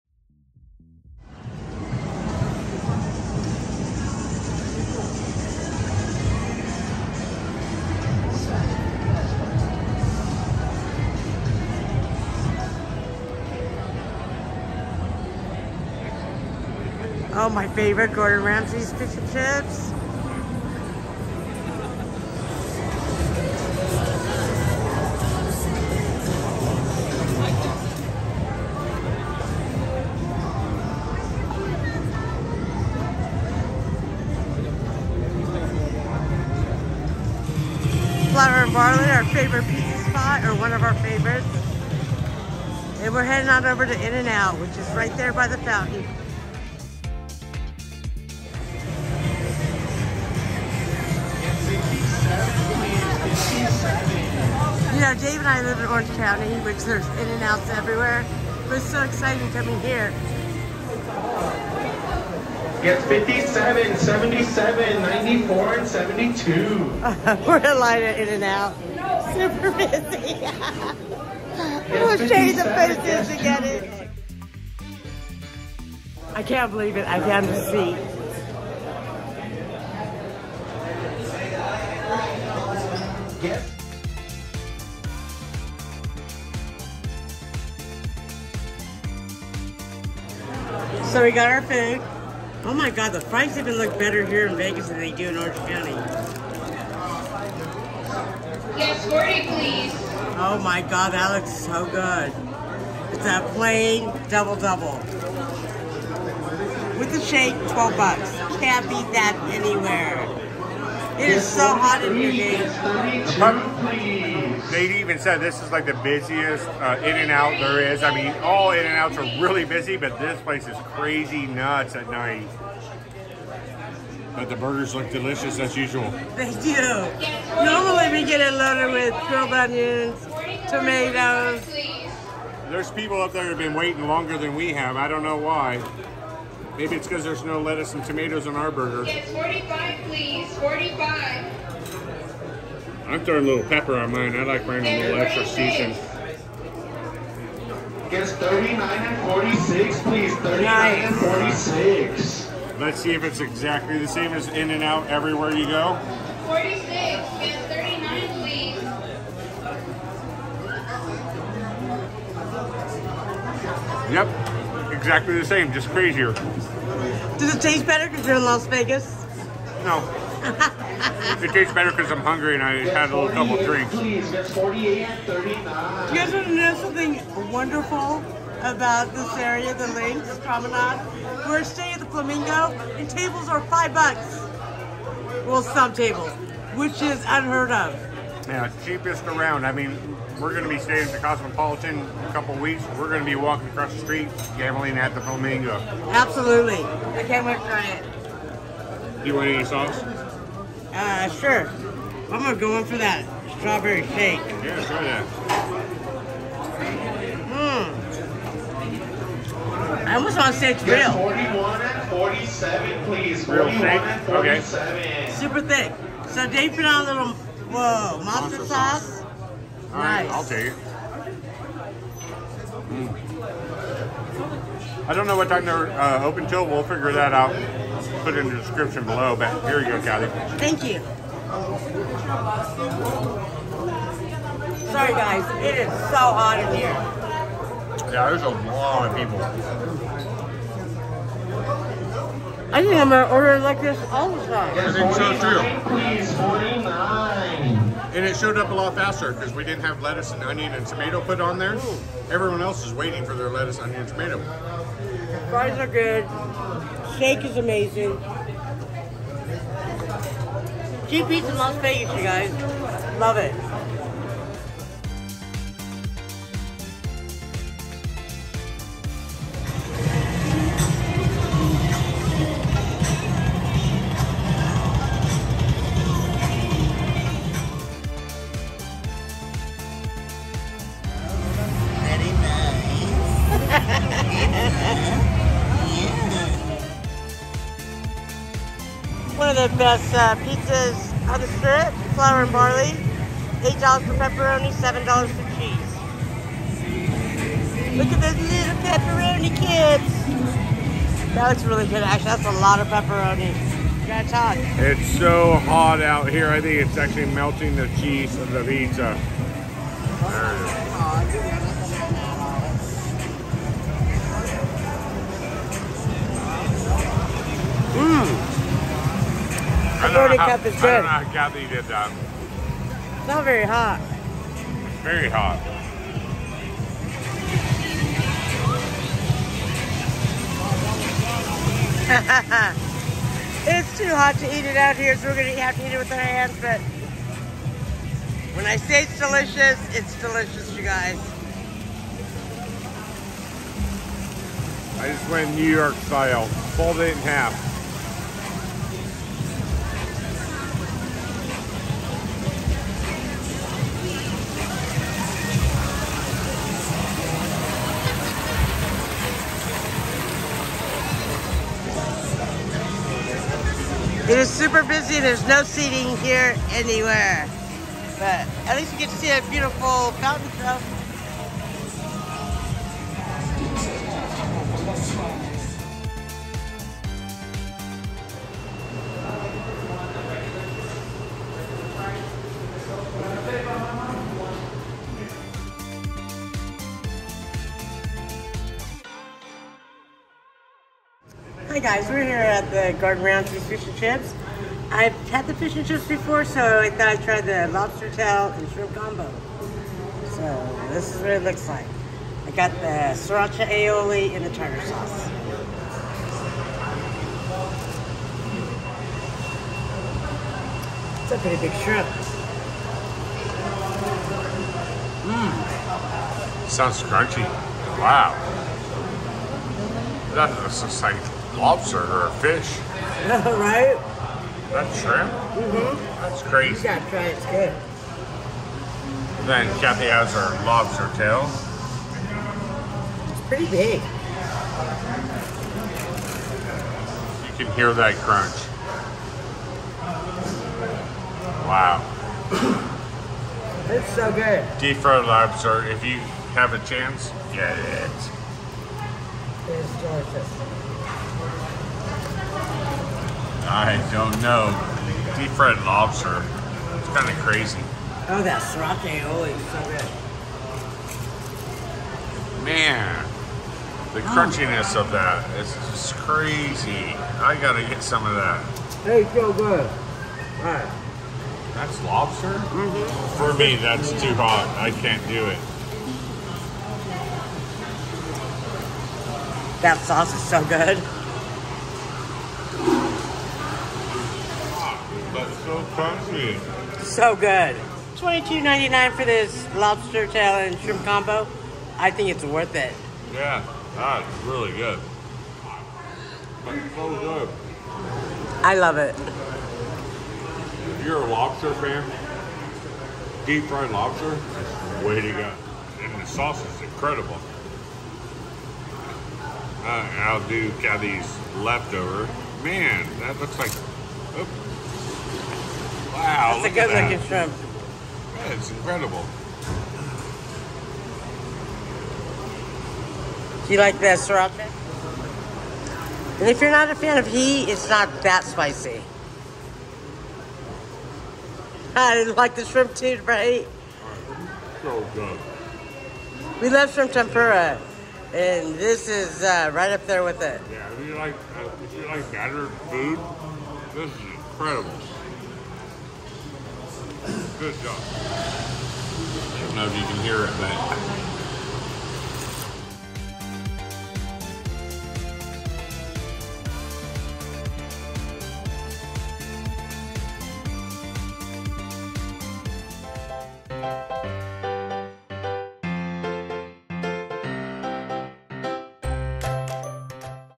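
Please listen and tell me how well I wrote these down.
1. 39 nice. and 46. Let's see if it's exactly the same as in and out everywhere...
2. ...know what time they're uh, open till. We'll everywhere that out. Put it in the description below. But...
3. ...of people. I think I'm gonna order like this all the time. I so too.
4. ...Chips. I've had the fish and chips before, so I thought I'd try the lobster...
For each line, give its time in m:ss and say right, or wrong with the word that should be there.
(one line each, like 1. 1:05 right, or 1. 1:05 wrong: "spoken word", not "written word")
1. 2:30 right
2. 3:45 wrong: "figure", not "everywhere"
3. 3:59 right
4. 6:33 right.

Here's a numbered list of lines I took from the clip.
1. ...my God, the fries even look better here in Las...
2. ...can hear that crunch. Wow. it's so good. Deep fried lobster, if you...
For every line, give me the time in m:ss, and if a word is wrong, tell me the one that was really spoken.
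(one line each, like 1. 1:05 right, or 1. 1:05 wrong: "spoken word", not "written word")
1. 1:32 wrong: "Vegas", not "Las"
2. 7:17 right.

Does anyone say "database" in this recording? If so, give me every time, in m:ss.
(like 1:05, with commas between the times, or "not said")
not said.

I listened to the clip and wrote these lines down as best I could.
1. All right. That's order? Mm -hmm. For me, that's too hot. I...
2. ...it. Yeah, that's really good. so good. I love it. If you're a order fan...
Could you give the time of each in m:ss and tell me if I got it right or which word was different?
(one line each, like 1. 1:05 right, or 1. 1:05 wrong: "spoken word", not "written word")
1. 7:49 wrong: "lobster", not "order"
2. 8:12 wrong: "lobster", not "order".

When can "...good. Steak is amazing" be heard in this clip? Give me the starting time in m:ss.
4:15.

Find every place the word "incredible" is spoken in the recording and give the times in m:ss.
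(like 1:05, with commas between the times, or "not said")
8:26, 8:38, 9:04.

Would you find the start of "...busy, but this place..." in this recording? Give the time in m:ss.
1:59.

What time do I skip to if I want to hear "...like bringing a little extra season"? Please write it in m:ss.
2:24.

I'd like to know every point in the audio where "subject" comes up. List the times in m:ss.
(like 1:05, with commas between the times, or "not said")
not said.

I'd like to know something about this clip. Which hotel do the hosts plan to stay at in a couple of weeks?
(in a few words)
Cosmopolitan.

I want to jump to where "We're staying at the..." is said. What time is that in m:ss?
3:01.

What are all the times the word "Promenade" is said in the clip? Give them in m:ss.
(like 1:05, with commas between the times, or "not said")
3:00.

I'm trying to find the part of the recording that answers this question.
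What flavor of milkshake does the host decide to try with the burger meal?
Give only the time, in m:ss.
3:23.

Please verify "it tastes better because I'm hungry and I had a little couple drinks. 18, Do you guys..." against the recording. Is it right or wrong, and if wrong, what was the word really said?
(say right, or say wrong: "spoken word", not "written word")
wrong: "48", not "18".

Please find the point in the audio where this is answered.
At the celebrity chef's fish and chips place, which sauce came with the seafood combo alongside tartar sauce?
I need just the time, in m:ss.
6:43.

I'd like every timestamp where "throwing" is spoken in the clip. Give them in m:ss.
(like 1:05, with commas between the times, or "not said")
2:23.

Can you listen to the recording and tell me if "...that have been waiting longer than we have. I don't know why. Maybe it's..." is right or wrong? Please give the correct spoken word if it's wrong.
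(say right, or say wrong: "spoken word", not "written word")
right.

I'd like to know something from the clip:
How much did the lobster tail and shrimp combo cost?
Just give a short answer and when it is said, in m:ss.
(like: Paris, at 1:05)
$22.99, at 8:08.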